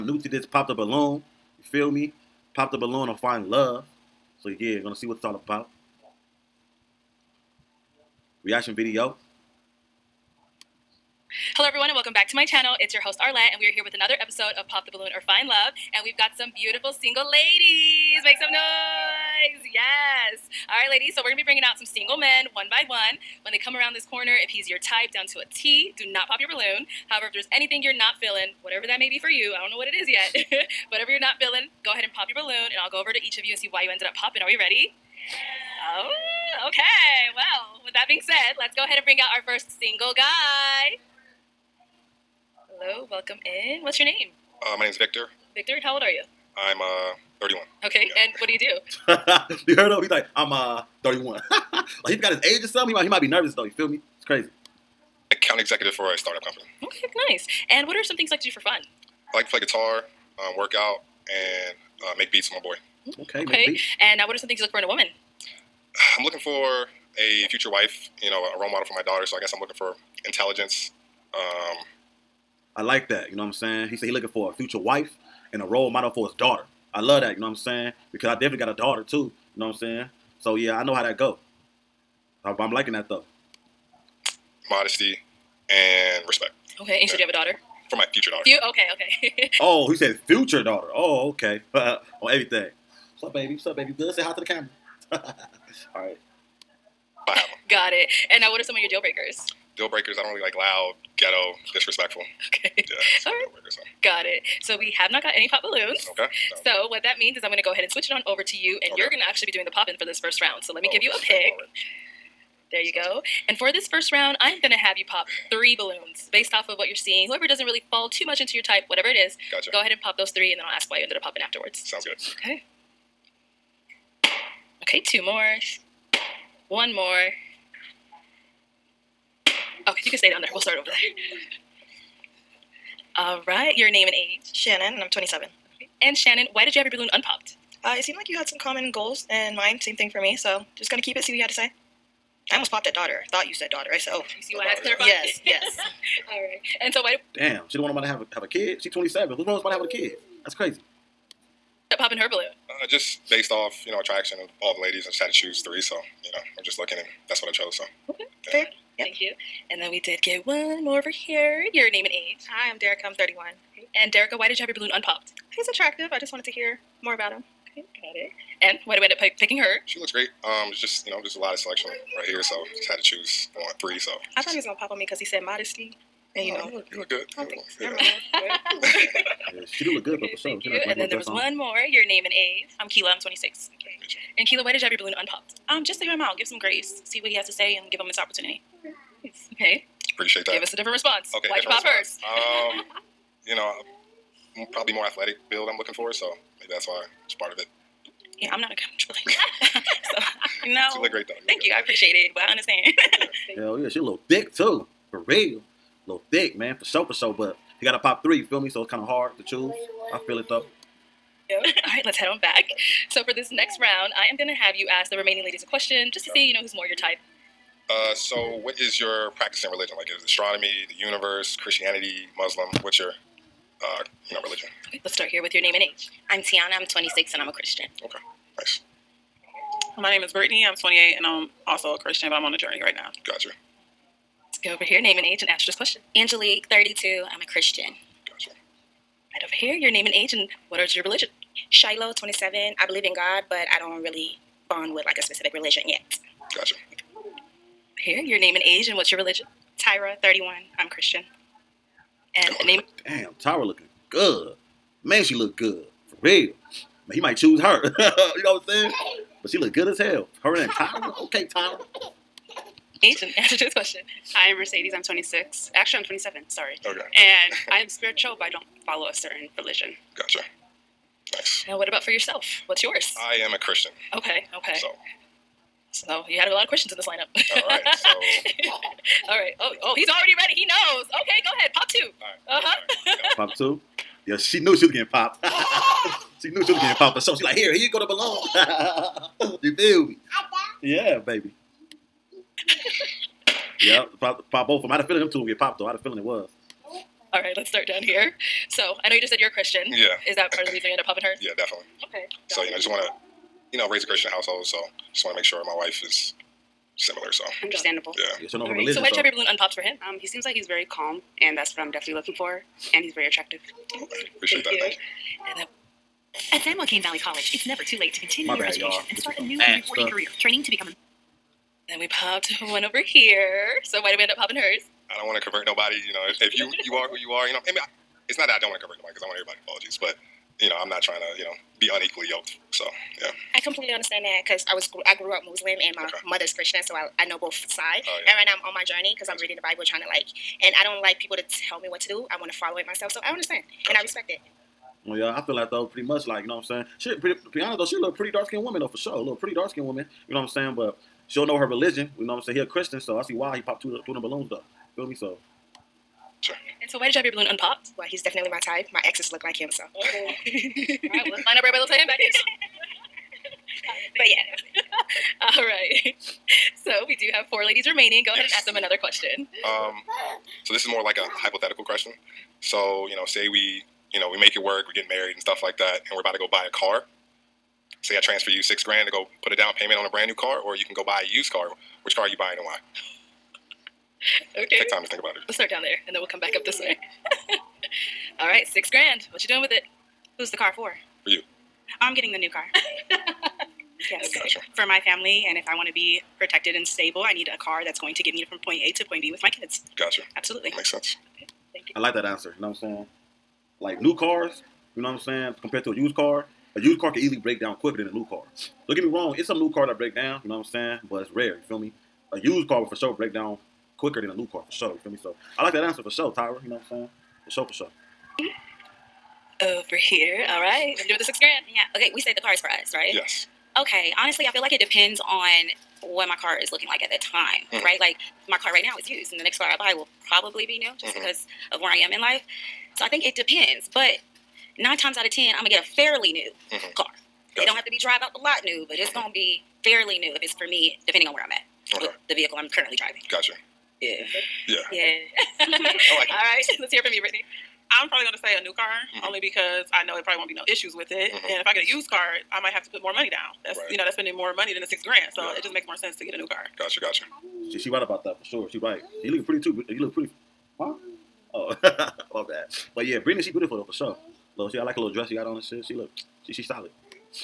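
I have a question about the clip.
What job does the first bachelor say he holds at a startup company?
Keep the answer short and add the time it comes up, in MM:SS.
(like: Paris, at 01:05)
Account executive, at 00:55.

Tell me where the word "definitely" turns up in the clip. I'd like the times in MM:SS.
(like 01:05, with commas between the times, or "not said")
01:18, 05:01, 05:11, 05:58.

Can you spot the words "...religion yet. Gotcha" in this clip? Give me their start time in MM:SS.
04:05.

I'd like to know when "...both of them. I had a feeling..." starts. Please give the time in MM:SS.
04:54.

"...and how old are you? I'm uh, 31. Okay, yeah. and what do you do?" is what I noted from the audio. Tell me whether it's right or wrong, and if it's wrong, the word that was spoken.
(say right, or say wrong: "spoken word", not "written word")
right.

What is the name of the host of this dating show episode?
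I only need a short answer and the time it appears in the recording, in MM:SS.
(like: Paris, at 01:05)
Arlette, at 00:13.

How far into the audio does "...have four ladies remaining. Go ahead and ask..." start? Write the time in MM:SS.
06:07.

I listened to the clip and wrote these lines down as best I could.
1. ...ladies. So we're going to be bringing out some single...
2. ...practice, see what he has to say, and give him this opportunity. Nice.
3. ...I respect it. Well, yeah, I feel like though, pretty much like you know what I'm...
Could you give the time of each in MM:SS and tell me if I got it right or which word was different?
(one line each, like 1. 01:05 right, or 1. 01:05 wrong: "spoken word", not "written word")
1. 00:20 right
2. 03:06 wrong: "grace", not "practice"
3. 05:43 right.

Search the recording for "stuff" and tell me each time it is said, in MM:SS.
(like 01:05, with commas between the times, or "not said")
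05:20, 06:15.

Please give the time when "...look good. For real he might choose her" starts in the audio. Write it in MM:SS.
04:15.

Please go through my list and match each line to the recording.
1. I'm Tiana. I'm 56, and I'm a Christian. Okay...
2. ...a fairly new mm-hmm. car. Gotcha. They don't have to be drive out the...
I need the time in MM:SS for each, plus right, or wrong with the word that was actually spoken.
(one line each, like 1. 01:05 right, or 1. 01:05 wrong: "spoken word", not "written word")
1. 03:46 wrong: "26", not "56"
2. 07:15 right.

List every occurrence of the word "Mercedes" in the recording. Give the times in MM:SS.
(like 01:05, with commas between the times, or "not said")
04:24.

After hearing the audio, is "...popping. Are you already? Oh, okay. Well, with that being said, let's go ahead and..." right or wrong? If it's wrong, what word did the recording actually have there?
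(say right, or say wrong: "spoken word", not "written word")
wrong: "ready", not "already".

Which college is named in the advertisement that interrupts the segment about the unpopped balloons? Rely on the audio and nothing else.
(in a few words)
San Joaquin Valley College.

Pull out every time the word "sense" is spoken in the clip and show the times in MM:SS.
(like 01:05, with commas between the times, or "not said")
06:40, 07:35.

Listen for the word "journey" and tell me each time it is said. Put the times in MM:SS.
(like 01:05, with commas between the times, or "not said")
03:52, 05:38.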